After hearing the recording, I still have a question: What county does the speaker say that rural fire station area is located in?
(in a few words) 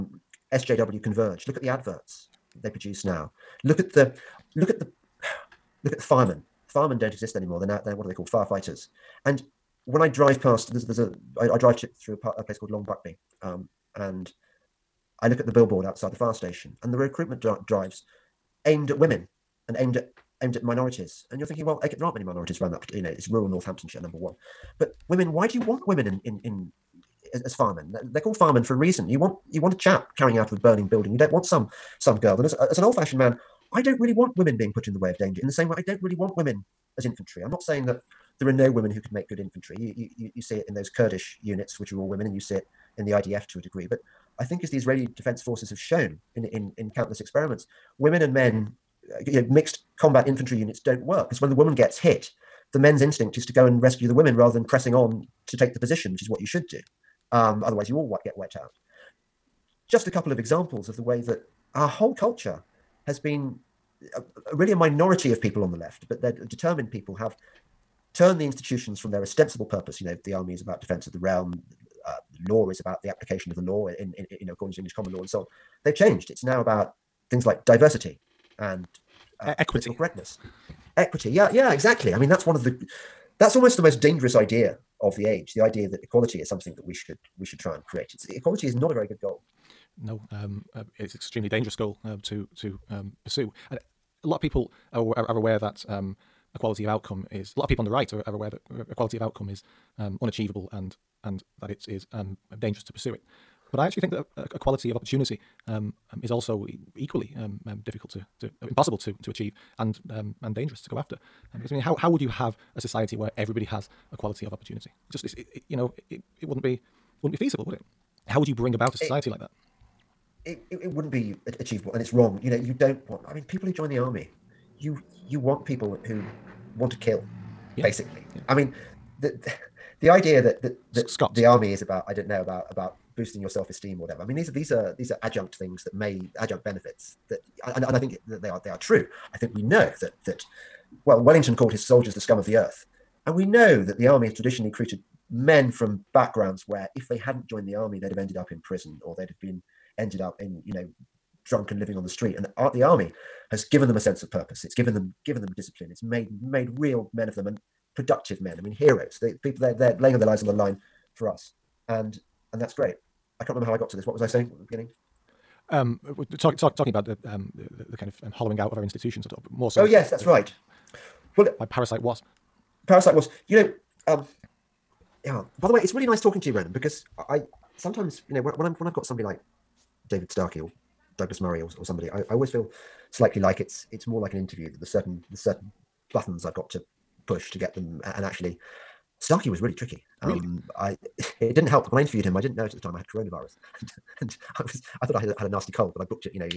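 Northamptonshire.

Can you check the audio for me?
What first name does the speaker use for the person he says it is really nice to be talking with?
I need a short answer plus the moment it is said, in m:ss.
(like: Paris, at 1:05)
Ronan, at 2:56.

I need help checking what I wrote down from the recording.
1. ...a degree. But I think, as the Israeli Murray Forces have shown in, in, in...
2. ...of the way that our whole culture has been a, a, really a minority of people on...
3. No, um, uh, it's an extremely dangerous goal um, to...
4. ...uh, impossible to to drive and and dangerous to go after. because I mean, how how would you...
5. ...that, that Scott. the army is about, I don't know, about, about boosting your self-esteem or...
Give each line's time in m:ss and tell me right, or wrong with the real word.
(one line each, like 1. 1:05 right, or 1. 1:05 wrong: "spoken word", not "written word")
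1. 0:43 wrong: "Defense", not "Murray"
2. 1:00 right
3. 1:30 right
4. 1:48 wrong: "achieve", not "drive"
5. 2:10 right.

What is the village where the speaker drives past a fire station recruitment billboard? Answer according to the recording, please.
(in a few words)
Long Buckby.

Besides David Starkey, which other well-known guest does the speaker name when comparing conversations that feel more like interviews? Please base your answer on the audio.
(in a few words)
Douglas Murray.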